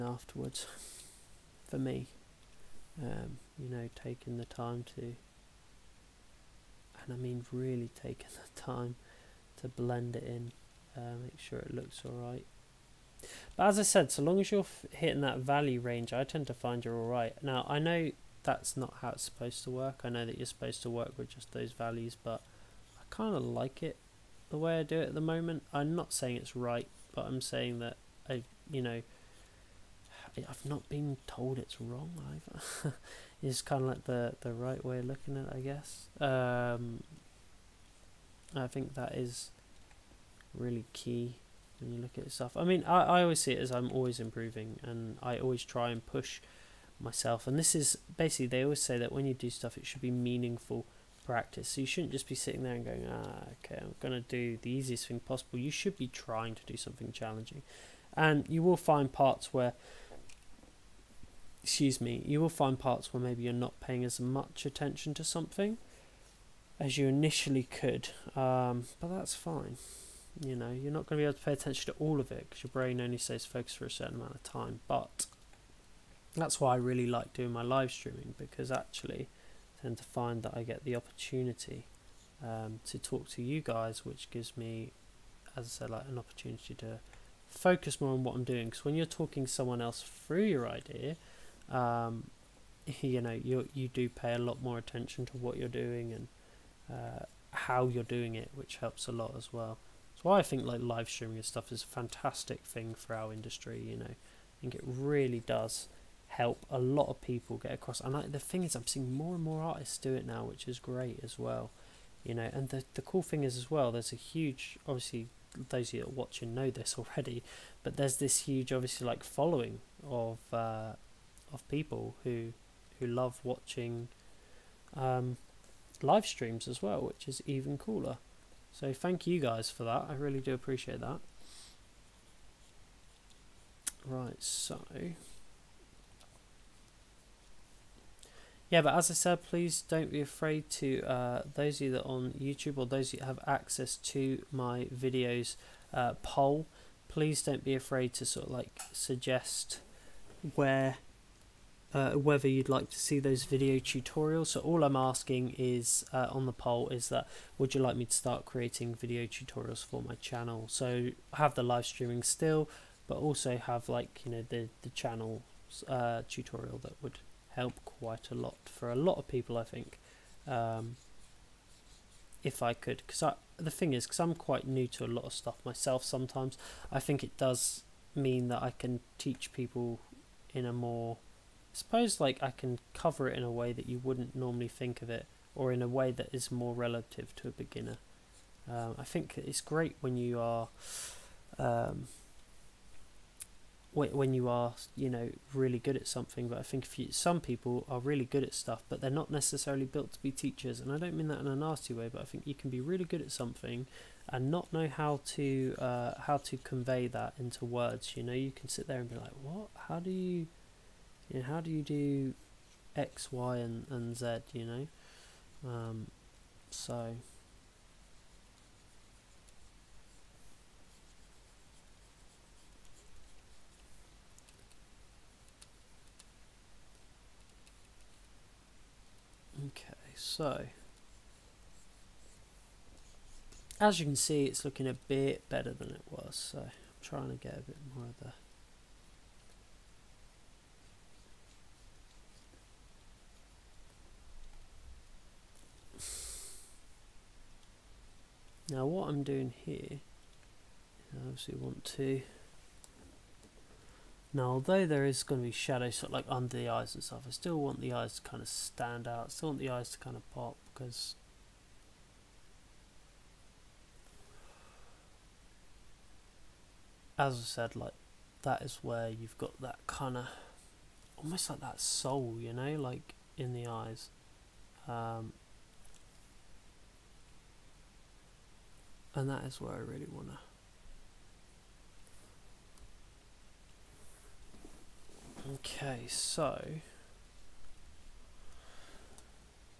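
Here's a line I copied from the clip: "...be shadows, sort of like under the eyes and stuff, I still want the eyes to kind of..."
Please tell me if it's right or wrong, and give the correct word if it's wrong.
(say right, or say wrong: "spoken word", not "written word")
right.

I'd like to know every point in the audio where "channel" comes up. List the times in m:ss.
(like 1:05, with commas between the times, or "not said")
2:40, 2:44.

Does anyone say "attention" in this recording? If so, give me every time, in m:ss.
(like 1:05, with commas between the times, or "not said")
1:04, 1:11, 1:34.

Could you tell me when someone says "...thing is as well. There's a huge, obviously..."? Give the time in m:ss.
1:53.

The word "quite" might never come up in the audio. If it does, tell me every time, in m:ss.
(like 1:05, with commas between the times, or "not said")
2:47, 2:54.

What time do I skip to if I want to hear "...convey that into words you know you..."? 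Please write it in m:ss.
3:26.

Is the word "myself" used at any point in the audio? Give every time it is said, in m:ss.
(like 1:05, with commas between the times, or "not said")
0:47, 2:55.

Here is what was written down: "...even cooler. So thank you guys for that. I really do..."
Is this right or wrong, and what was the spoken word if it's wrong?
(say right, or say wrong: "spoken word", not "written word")
right.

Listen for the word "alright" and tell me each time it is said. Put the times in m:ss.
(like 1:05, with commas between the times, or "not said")
0:12, 0:16.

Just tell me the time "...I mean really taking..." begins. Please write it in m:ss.
0:07.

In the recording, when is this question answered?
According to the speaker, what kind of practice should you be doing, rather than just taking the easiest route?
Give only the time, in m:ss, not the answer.
0:50.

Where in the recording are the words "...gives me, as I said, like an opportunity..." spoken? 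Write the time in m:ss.
1:24.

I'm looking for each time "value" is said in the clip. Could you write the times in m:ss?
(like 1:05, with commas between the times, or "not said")
0:15, 0:21.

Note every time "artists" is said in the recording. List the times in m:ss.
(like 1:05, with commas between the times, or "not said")
1:49.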